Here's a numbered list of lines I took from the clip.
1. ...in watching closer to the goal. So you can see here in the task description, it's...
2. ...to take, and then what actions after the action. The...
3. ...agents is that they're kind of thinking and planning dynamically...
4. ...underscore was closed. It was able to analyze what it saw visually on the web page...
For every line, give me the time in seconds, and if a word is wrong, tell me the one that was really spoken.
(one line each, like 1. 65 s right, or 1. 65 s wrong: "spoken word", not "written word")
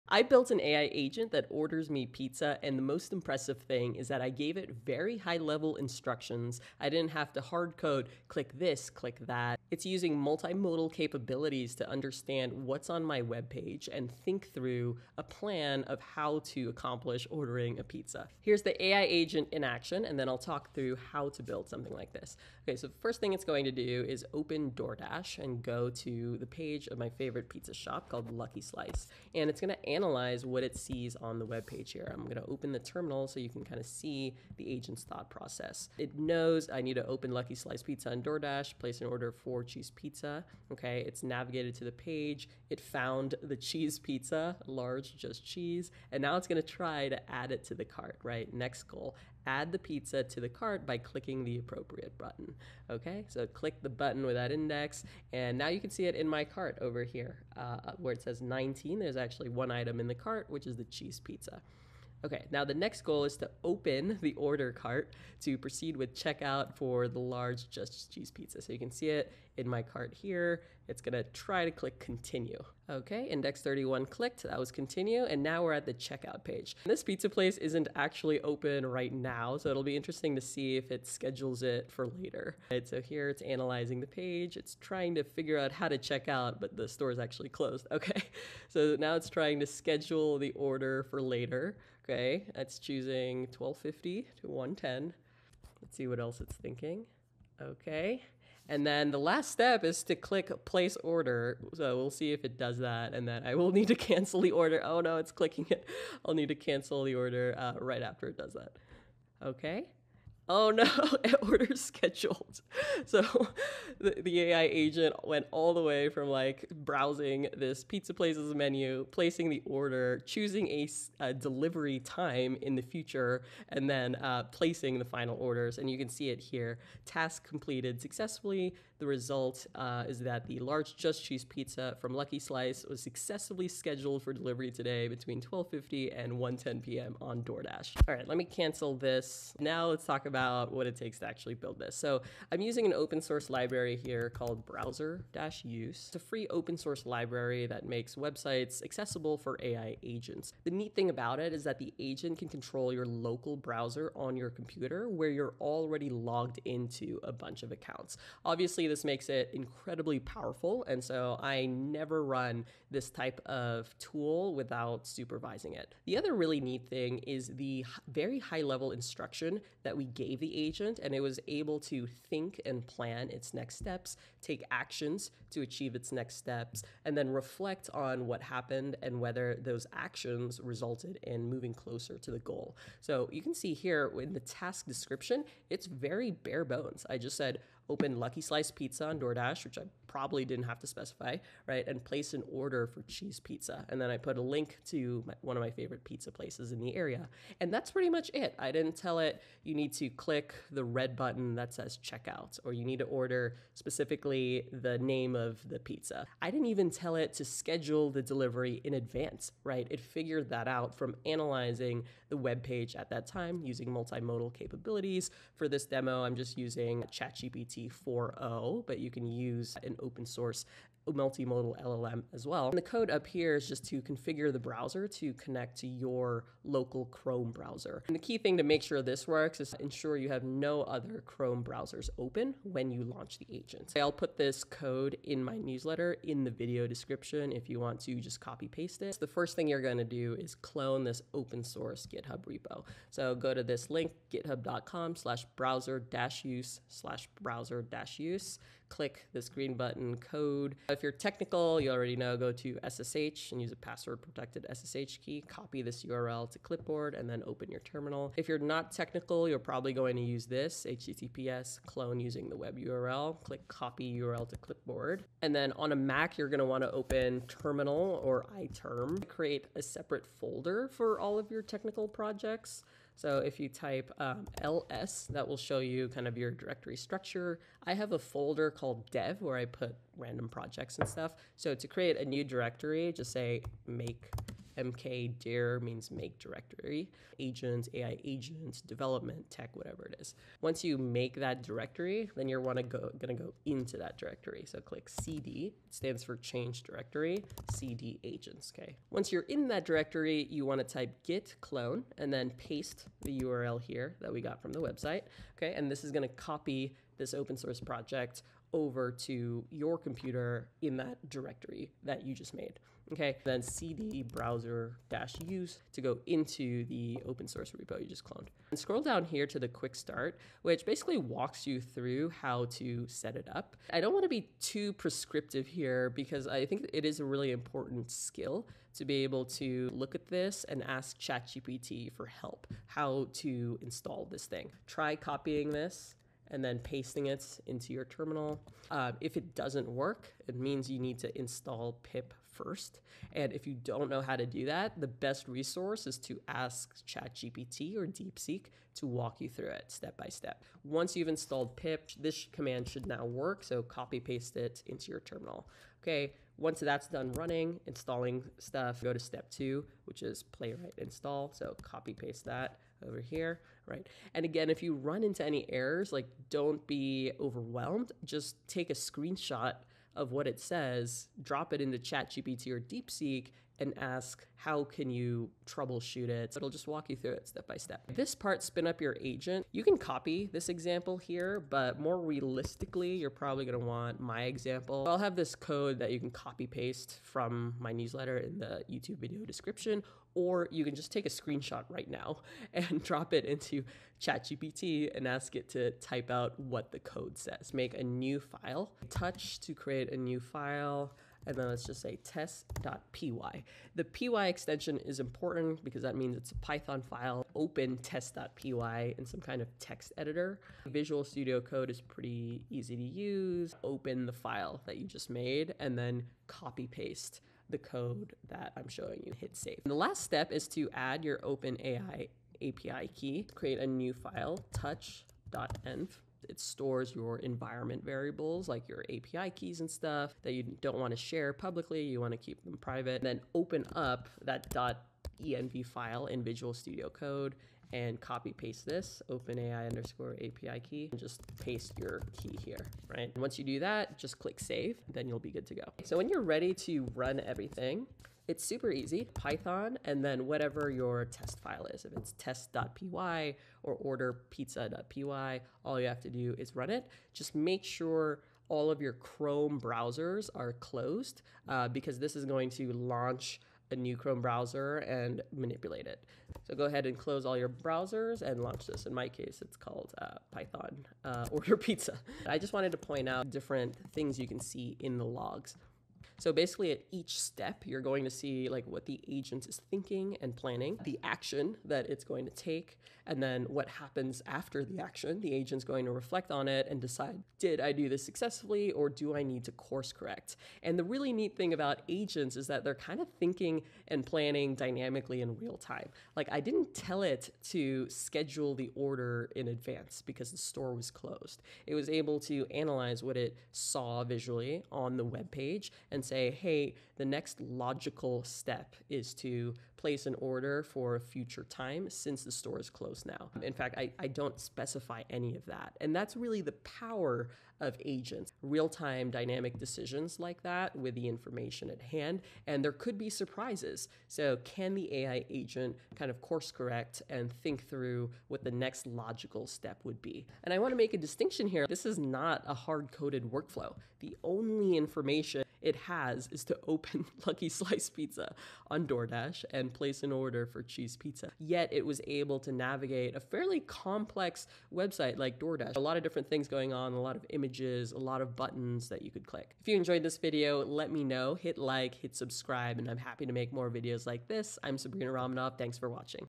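1. 181 s wrong: "moving", not "watching"
2. 482 s wrong: "happens", not "actions"
3. 492 s right
4. 500 s wrong: "store", not "underscore".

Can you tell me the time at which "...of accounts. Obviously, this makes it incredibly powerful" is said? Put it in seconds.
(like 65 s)
157 s.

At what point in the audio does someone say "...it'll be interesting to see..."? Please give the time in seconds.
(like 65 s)
79 s.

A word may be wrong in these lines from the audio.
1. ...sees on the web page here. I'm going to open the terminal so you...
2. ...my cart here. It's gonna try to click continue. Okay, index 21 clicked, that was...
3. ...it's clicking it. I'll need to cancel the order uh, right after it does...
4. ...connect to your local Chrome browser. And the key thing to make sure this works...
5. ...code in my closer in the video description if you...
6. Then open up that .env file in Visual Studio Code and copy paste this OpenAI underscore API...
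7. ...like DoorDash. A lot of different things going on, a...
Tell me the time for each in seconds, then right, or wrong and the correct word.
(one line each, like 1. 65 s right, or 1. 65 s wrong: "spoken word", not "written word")
1. 30 s right
2. 69 s wrong: "31", not "21"
3. 105 s right
4. 225 s right
5. 234 s wrong: "newsletter", not "closer"
6. 433 s right
7. 545 s right.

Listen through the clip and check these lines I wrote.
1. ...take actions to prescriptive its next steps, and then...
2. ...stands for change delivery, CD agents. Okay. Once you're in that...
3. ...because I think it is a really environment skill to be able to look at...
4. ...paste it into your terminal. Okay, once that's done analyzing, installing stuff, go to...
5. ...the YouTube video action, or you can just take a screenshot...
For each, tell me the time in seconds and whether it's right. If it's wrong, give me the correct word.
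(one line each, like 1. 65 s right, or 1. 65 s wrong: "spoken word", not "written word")
1. 174 s wrong: "achieve", not "prescriptive"
2. 295 s wrong: "directory", not "delivery"
3. 326 s wrong: "important", not "environment"
4. 354 s wrong: "running", not "analyzing"
5. 388 s wrong: "description", not "action".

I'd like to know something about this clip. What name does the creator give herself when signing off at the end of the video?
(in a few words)
Sabrina Ramonov.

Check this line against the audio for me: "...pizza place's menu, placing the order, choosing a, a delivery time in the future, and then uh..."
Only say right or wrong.
right.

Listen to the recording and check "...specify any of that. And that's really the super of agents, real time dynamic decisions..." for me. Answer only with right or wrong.
wrong.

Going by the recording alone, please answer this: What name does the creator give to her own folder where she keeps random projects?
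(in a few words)
dev.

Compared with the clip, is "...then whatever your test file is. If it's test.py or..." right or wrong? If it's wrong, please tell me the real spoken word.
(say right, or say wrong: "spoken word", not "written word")
right.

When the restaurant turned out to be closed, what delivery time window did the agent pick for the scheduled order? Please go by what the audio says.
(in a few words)
12:50 to 1:10.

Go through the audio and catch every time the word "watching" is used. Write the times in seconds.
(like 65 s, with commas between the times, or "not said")
556 s.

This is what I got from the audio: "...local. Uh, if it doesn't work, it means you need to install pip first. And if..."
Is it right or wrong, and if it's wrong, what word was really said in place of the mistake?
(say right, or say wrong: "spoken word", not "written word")
wrong: "terminal", not "local".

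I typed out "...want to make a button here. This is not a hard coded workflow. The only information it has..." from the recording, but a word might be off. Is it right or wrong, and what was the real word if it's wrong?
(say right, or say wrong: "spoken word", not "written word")
wrong: "distinction", not "button".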